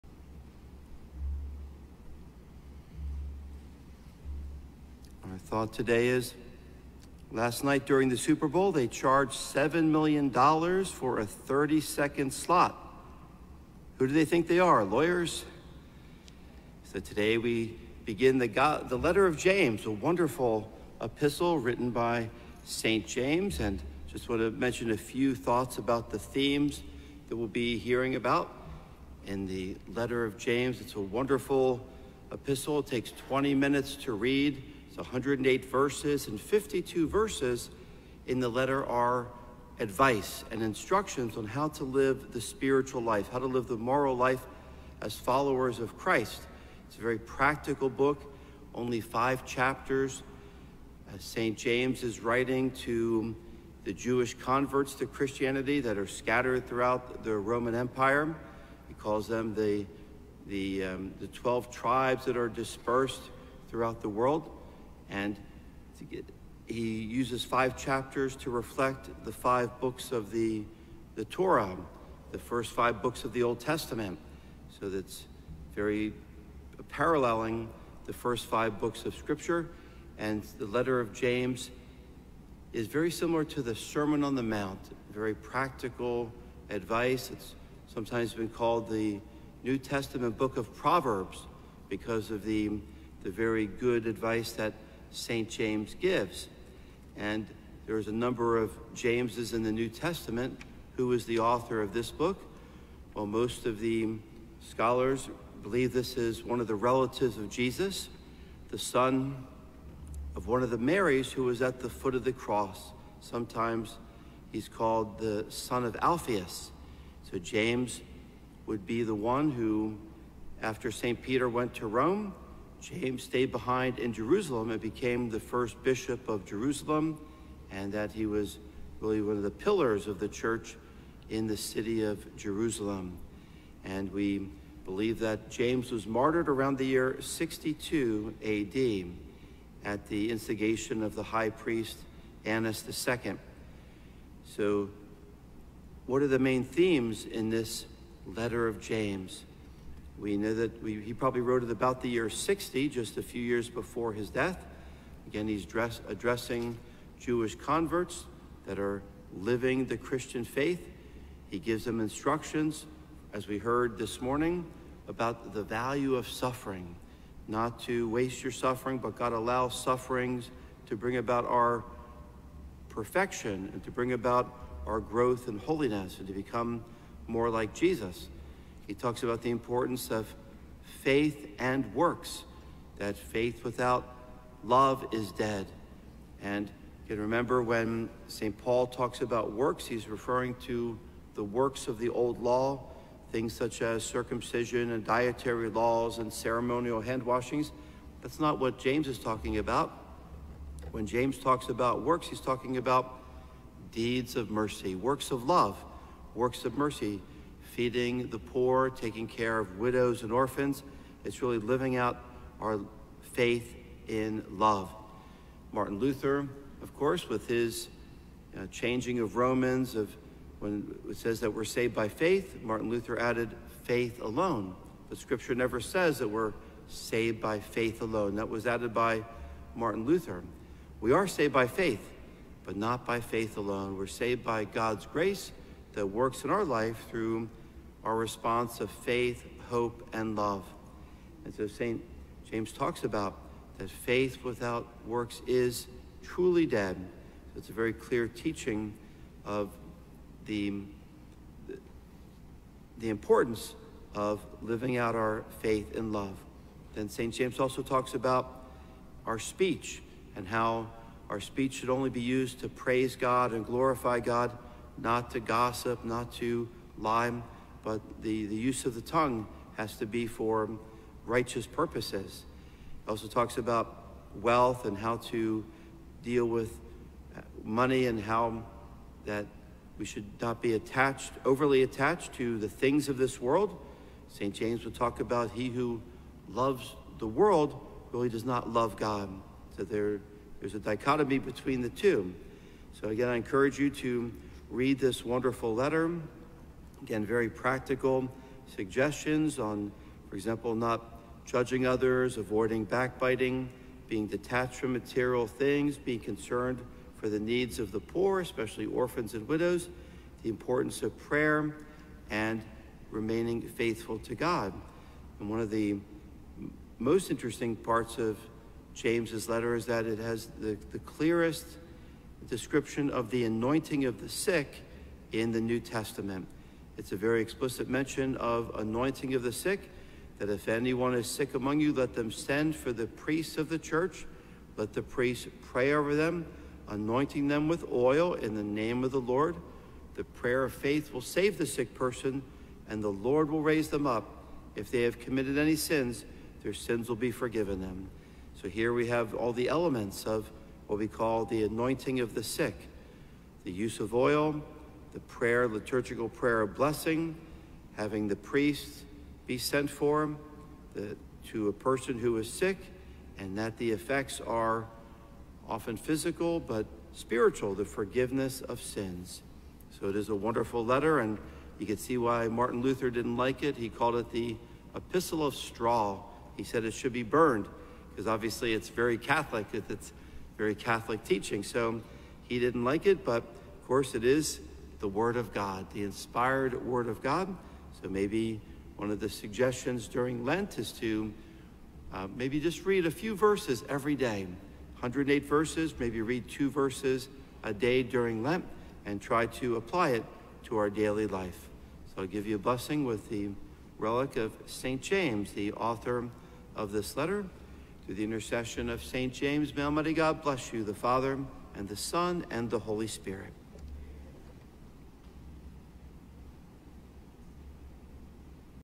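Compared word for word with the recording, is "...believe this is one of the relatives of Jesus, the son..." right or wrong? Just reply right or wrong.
right.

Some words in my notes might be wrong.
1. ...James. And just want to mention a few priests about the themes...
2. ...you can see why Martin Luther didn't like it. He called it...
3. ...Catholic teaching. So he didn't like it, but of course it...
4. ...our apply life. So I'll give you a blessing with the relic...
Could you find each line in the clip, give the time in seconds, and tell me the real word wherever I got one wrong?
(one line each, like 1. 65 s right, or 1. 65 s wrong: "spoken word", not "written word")
1. 23 s wrong: "thoughts", not "priests"
2. 371 s right
3. 380 s right
4. 400 s wrong: "daily", not "apply".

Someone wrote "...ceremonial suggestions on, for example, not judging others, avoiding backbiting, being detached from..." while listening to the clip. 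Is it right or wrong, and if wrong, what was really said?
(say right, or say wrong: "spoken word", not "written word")
wrong: "practical", not "ceremonial".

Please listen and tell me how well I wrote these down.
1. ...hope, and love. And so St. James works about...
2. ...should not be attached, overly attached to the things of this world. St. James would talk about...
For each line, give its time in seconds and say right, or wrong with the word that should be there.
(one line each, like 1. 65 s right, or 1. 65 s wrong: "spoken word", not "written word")
1. 239 s wrong: "talks", not "works"
2. 280 s right.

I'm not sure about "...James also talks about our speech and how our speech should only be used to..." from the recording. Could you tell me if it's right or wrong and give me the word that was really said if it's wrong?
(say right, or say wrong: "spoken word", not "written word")
right.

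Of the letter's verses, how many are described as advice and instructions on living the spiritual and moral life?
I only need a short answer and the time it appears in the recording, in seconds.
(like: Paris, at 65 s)
52, at 36 s.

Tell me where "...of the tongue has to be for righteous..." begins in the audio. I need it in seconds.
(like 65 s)
268 s.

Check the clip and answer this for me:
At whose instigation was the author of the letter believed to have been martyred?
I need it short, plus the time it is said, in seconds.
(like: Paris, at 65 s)
Annas II, at 142 s.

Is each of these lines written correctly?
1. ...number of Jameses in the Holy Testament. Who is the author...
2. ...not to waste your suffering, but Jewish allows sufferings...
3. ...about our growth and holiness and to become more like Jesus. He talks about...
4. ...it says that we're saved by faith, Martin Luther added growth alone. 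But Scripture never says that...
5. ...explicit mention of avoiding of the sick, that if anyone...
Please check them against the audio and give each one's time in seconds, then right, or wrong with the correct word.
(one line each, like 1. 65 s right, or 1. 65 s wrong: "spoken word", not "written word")
1. 98 s wrong: "New", not "Holy"
2. 167 s wrong: "God", not "Jewish"
3. 174 s right
4. 221 s wrong: "faith", not "growth"
5. 327 s wrong: "anointing", not "avoiding".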